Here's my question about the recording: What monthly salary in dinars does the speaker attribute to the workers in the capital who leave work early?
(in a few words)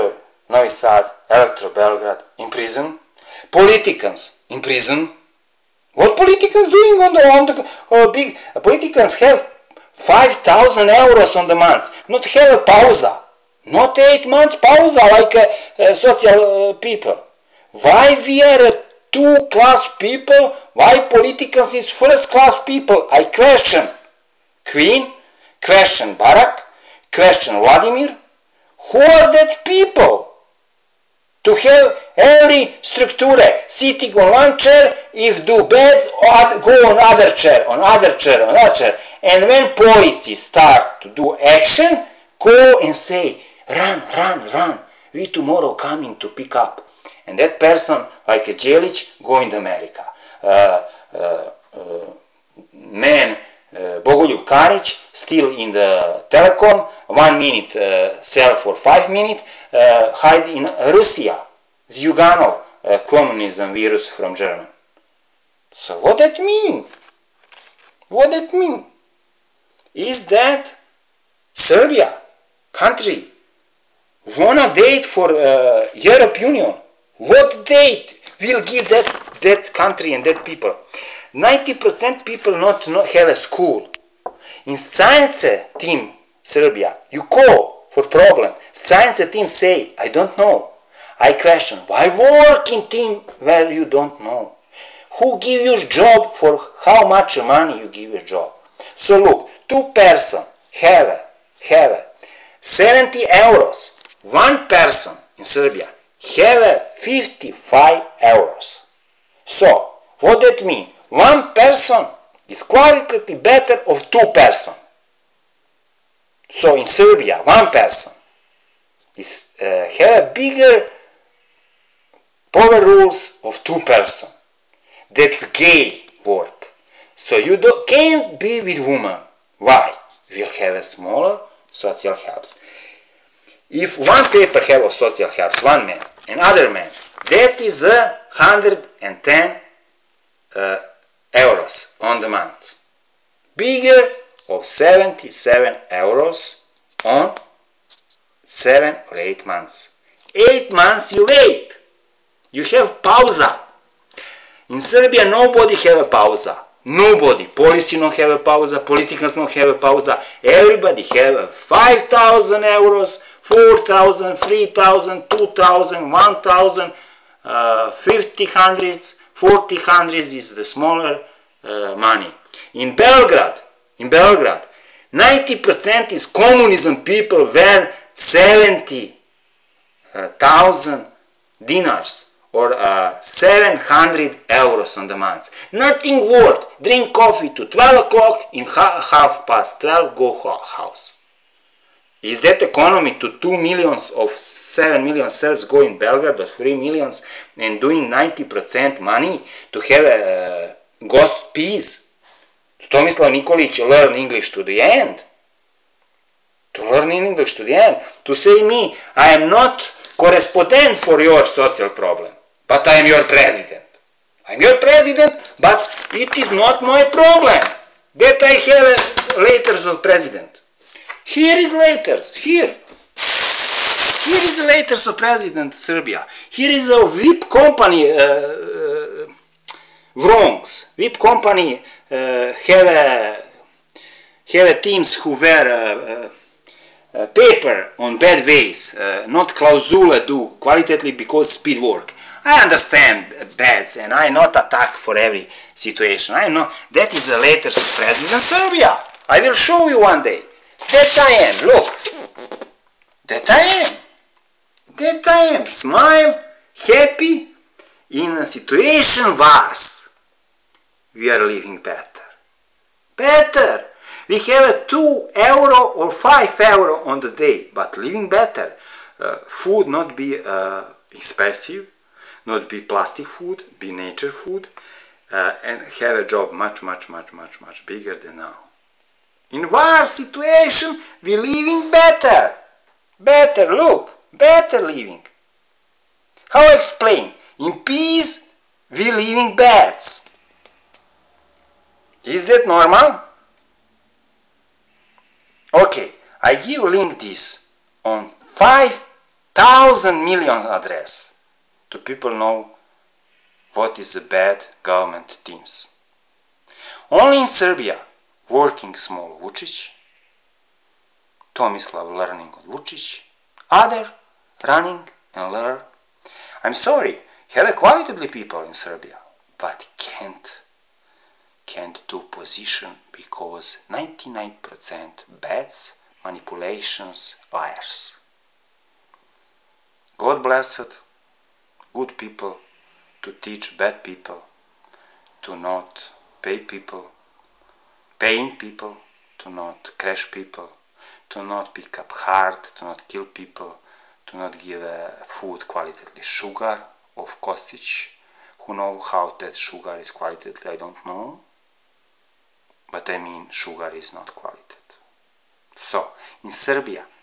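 70,000 dinars.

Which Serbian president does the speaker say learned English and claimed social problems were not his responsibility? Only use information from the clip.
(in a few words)
Tomislav Nikolic.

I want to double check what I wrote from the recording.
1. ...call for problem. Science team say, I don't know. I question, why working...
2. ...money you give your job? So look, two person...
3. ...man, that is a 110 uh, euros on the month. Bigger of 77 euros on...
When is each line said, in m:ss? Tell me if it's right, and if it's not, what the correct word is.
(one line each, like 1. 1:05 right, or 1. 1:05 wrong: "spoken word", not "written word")
1. 1:27 right
2. 1:37 right
3. 2:16 right.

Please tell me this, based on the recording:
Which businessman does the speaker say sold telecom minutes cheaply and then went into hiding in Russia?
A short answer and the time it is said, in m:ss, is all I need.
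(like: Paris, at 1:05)
Bogoljub Karic, at 0:54.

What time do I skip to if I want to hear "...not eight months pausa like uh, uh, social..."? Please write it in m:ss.
0:13.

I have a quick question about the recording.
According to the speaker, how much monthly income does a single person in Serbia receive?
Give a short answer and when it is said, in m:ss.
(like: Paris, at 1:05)
55 euros, at 1:46.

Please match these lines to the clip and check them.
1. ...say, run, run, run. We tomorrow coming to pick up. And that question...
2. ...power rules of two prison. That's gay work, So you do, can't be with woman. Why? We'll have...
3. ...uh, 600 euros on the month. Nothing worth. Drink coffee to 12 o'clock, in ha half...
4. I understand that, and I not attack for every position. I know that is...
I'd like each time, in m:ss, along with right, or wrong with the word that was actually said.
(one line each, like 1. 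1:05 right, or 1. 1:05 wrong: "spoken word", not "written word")
1. 0:42 wrong: "person", not "question"
2. 2:02 wrong: "person", not "prison"
3. 3:02 wrong: "700", not "600"
4. 4:02 wrong: "situation", not "position".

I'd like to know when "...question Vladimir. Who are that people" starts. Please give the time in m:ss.
0:27.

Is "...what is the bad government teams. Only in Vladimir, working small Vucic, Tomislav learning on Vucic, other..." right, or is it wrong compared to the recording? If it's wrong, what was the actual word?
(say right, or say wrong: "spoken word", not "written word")
wrong: "Serbia", not "Vladimir".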